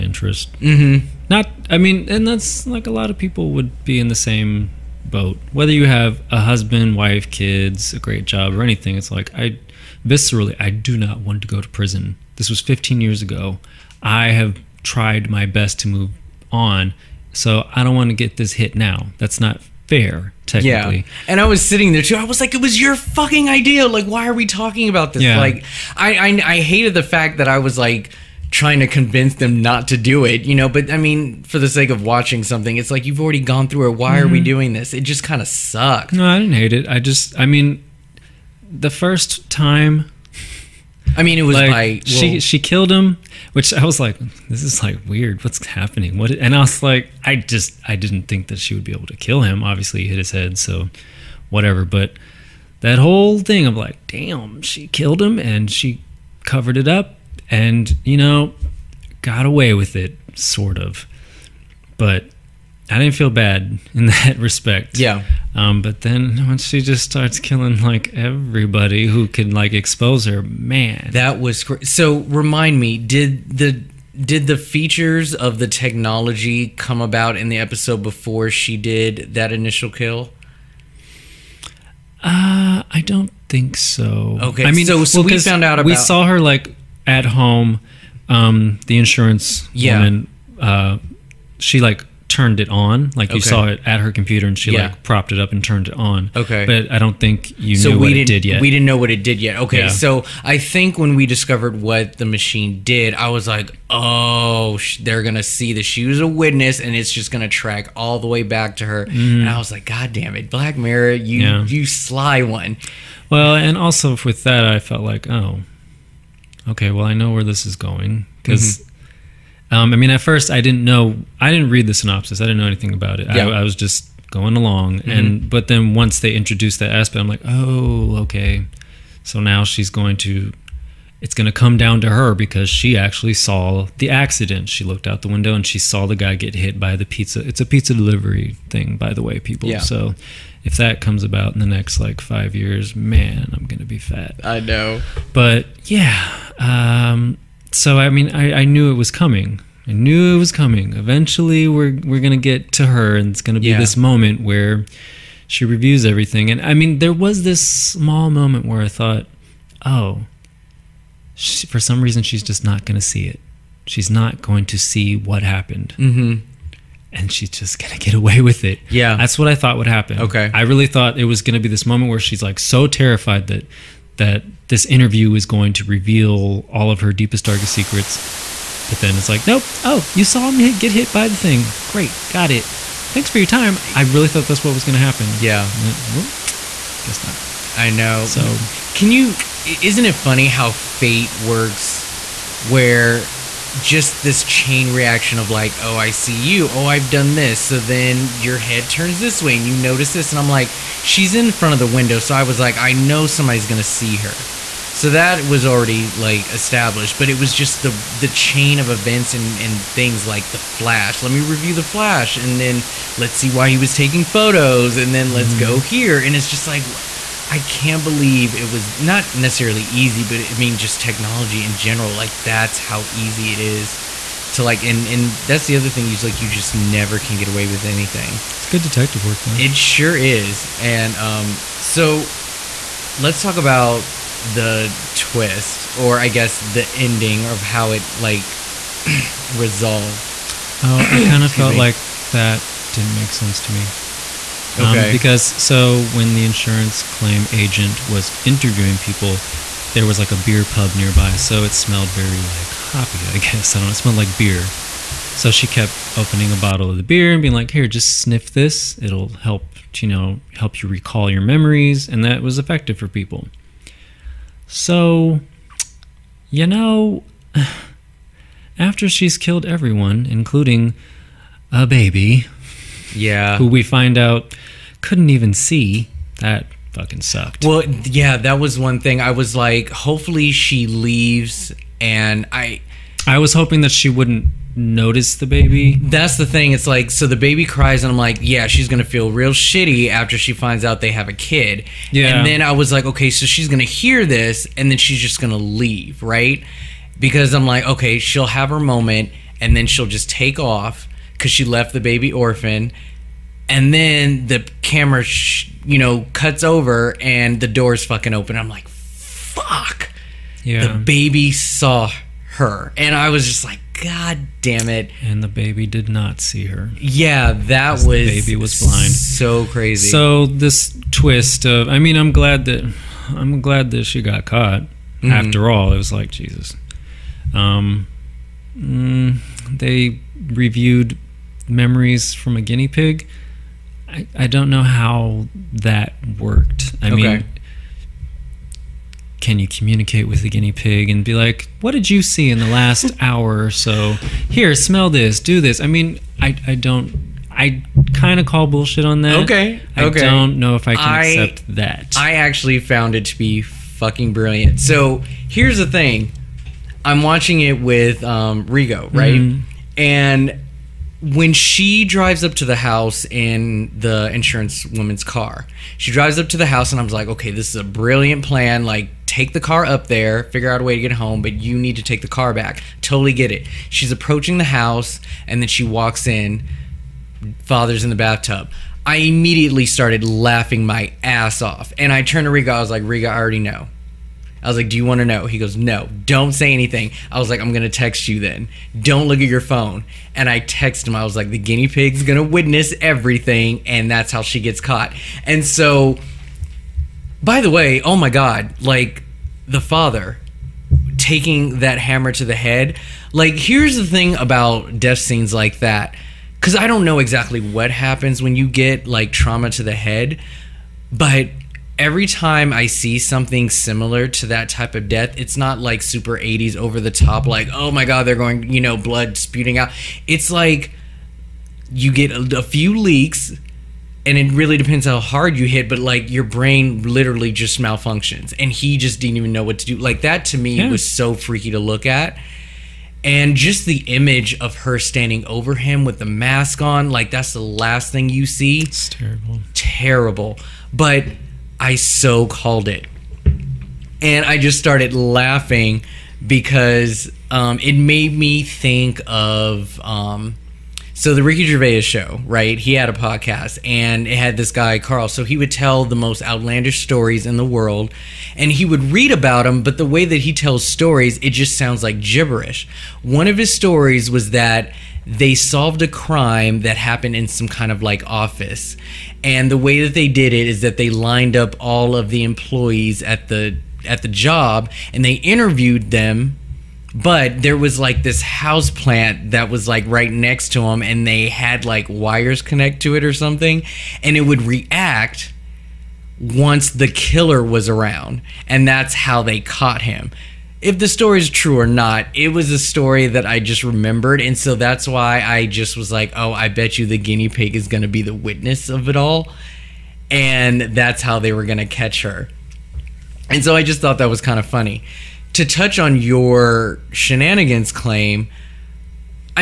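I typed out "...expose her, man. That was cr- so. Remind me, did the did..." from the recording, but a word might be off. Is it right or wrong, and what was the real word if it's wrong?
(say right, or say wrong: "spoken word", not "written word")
right.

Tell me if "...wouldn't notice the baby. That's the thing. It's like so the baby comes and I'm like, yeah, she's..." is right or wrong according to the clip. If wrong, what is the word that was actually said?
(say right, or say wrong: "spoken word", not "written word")
wrong: "cries", not "comes".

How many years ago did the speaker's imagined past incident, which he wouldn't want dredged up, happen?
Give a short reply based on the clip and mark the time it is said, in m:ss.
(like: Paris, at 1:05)
15, at 0:12.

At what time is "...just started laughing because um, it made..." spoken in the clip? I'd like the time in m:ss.
7:24.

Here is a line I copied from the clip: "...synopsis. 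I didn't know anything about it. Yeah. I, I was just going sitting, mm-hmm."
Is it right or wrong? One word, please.
wrong.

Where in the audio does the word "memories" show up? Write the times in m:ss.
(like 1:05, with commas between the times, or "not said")
4:21, 5:31.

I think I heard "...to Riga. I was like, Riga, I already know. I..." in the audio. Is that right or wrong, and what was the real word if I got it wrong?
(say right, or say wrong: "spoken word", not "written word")
right.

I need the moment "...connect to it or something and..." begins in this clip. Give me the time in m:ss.
8:02.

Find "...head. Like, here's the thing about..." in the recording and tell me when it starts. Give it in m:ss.
6:42.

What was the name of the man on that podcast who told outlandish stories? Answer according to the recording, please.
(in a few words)
Karl.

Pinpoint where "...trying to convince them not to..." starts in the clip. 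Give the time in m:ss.
0:28.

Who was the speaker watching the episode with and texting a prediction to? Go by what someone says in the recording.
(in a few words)
Rigo.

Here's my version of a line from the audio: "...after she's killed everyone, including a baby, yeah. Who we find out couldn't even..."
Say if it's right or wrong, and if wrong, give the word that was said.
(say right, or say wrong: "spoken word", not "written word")
right.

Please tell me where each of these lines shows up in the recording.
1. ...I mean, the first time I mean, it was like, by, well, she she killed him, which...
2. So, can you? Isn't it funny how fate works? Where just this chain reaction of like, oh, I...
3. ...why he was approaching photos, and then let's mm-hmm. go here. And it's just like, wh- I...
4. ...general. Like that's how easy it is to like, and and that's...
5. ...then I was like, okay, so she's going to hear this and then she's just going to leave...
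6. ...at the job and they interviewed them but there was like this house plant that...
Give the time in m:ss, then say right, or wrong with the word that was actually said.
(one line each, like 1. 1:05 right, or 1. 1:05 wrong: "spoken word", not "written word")
1. 0:37 right
2. 3:08 right
3. 3:33 wrong: "taking", not "approaching"
4. 3:41 right
5. 4:52 right
6. 7:54 right.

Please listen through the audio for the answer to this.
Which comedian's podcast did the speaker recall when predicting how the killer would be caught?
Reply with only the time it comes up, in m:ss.
7:31.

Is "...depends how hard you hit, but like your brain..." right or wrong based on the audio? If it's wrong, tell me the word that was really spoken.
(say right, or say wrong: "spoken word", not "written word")
right.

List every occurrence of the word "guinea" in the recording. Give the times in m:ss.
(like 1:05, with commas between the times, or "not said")
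5:32, 5:40, 6:31, 8:17.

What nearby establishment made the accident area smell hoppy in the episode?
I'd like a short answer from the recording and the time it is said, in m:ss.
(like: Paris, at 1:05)
Beer pub, at 4:10.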